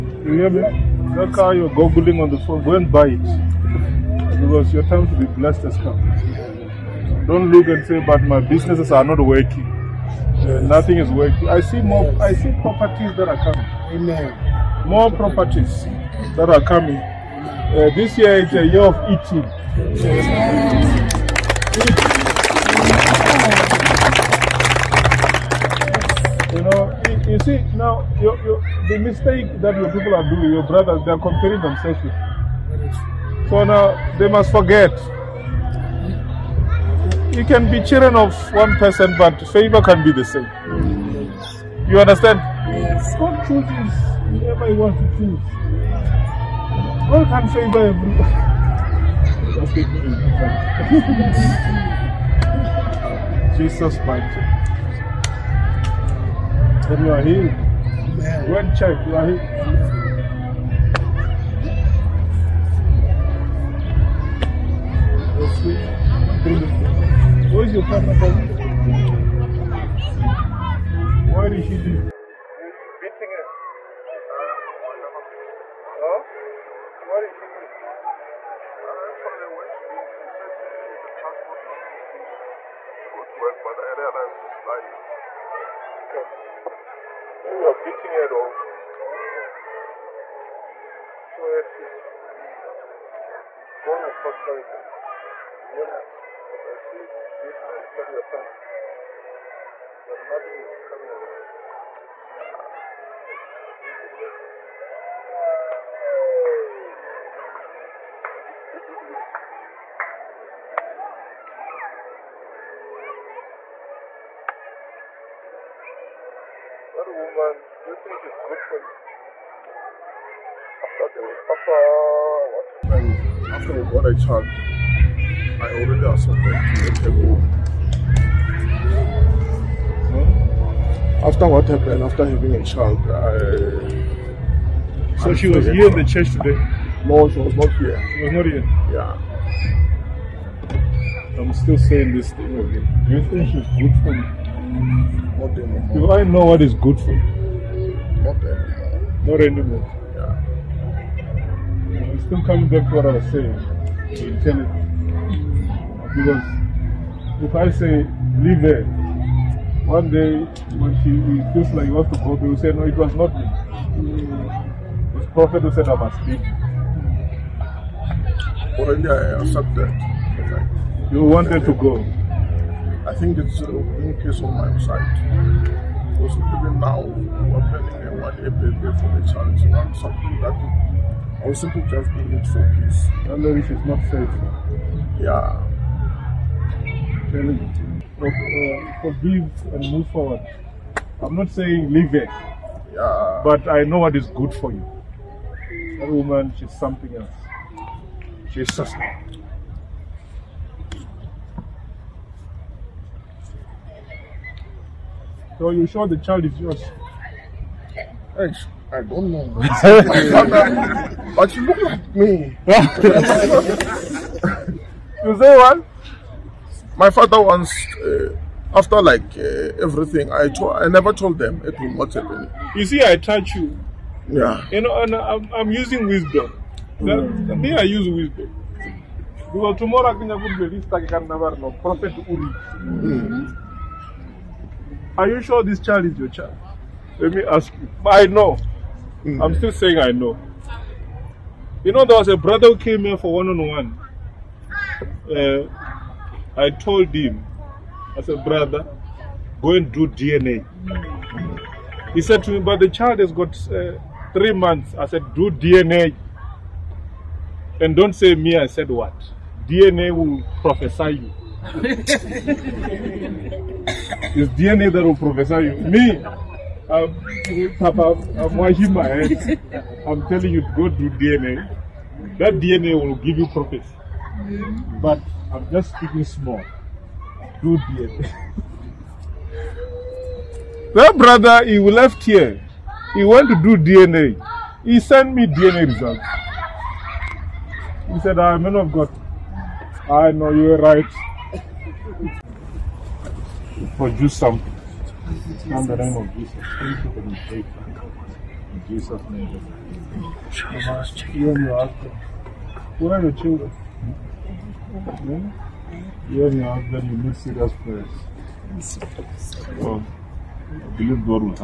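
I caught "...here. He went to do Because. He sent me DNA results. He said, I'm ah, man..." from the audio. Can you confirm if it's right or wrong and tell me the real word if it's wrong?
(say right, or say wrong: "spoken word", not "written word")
wrong: "DNA", not "Because".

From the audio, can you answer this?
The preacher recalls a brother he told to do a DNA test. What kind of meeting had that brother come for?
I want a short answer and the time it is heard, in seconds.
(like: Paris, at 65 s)
one on one, at 243 s.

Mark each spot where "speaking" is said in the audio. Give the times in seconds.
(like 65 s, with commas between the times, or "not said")
275 s.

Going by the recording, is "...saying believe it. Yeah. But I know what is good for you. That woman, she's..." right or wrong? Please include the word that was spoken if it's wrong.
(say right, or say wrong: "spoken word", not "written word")
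wrong: "leave", not "believe".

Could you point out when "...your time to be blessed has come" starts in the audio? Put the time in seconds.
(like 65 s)
4 s.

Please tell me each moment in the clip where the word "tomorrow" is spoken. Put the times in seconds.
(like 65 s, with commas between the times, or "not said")
229 s.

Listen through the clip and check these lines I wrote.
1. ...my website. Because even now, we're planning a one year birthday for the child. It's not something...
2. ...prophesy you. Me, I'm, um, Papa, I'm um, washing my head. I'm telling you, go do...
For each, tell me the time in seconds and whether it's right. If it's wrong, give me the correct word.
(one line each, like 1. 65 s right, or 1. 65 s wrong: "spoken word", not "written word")
1. 174 s right
2. 265 s right.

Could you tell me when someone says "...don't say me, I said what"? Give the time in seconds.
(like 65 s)
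257 s.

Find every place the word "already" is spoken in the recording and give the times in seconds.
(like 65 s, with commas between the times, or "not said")
125 s, 168 s.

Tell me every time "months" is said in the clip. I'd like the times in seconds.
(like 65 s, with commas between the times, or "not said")
254 s.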